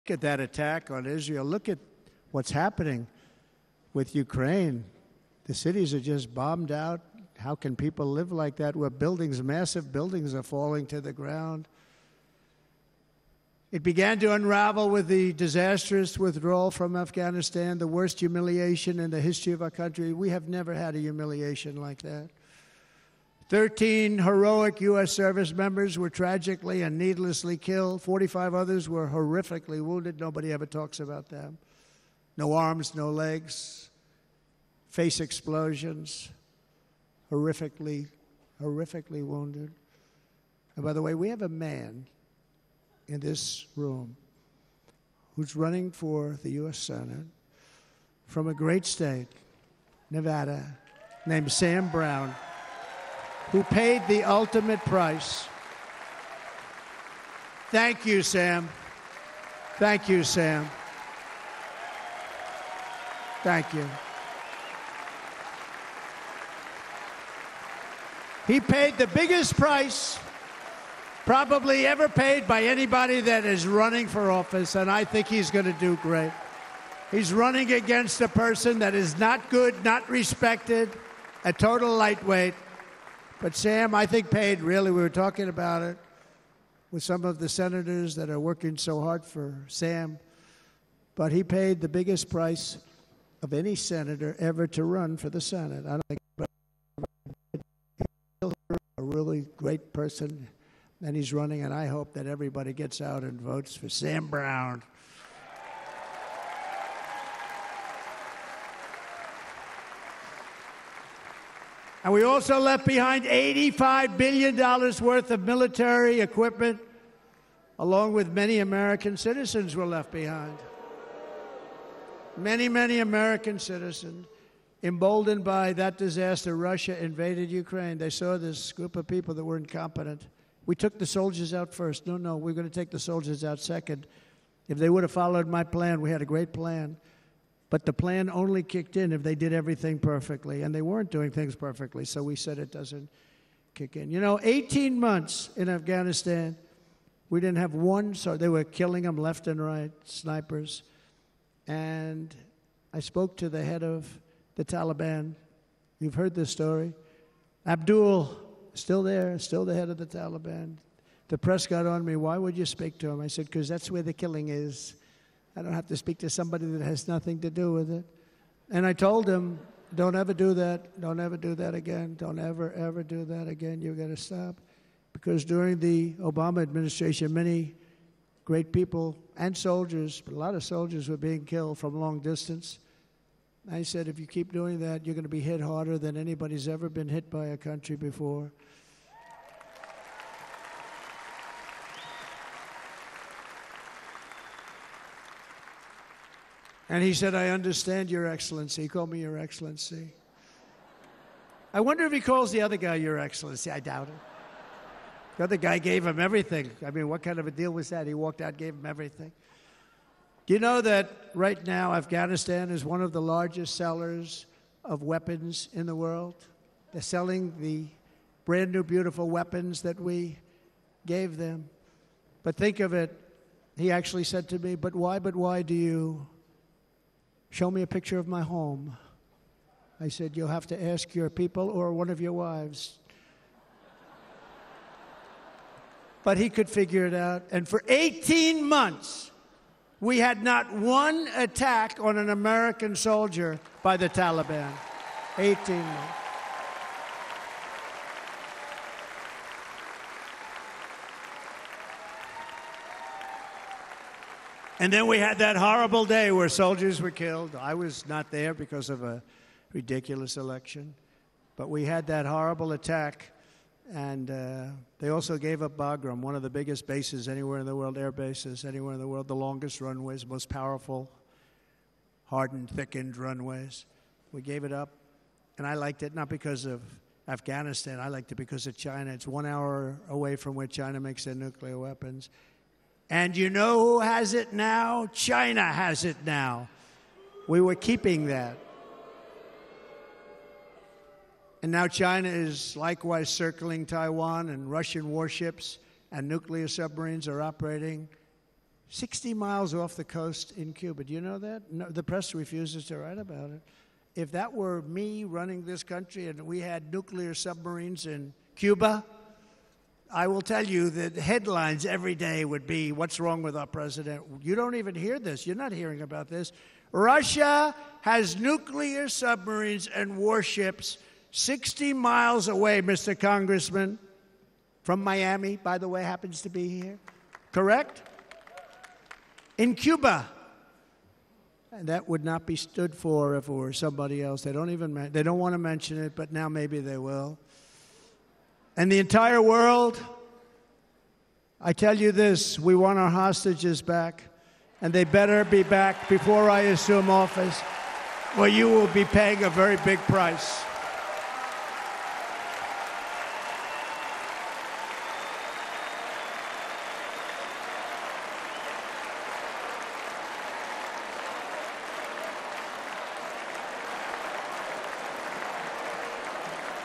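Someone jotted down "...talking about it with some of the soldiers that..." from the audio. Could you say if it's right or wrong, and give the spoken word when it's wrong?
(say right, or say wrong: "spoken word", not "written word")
wrong: "senators", not "soldiers".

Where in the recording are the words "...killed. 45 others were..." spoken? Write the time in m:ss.
0:27.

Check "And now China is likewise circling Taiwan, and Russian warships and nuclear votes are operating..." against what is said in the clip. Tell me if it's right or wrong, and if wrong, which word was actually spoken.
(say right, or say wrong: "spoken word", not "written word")
wrong: "submarines", not "votes".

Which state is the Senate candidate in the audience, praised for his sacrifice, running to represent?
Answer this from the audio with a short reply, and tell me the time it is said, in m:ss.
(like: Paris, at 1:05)
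Nevada, at 0:50.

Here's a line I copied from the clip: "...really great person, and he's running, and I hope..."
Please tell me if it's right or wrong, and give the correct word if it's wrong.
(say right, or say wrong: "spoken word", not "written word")
right.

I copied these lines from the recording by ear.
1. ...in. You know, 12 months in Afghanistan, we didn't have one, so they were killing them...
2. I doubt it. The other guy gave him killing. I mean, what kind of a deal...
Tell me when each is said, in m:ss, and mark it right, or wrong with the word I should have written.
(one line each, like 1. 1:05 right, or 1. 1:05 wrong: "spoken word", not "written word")
1. 2:23 wrong: "18", not "12"
2. 3:23 wrong: "everything", not "killing".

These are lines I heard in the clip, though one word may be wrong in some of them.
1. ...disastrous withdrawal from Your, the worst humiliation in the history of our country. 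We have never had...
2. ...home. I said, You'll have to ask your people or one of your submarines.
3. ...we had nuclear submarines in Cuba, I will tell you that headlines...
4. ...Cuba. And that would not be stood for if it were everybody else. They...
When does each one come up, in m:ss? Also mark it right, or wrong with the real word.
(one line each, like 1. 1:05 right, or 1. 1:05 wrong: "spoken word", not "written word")
1. 0:15 wrong: "Afghanistan", not "Your"
2. 3:48 wrong: "wives", not "submarines"
3. 5:06 right
4. 5:29 wrong: "somebody", not "everybody".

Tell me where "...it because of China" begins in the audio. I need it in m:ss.
4:38.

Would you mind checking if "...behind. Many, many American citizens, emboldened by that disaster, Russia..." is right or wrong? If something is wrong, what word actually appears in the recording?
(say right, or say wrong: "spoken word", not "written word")
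right.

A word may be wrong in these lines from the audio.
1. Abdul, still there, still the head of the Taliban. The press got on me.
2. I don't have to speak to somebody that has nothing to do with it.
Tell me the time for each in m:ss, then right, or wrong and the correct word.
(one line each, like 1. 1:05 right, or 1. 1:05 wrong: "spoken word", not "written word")
1. 2:37 right
2. 2:45 right.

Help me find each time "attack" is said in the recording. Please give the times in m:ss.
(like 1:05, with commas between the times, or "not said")
0:00, 4:01, 4:22.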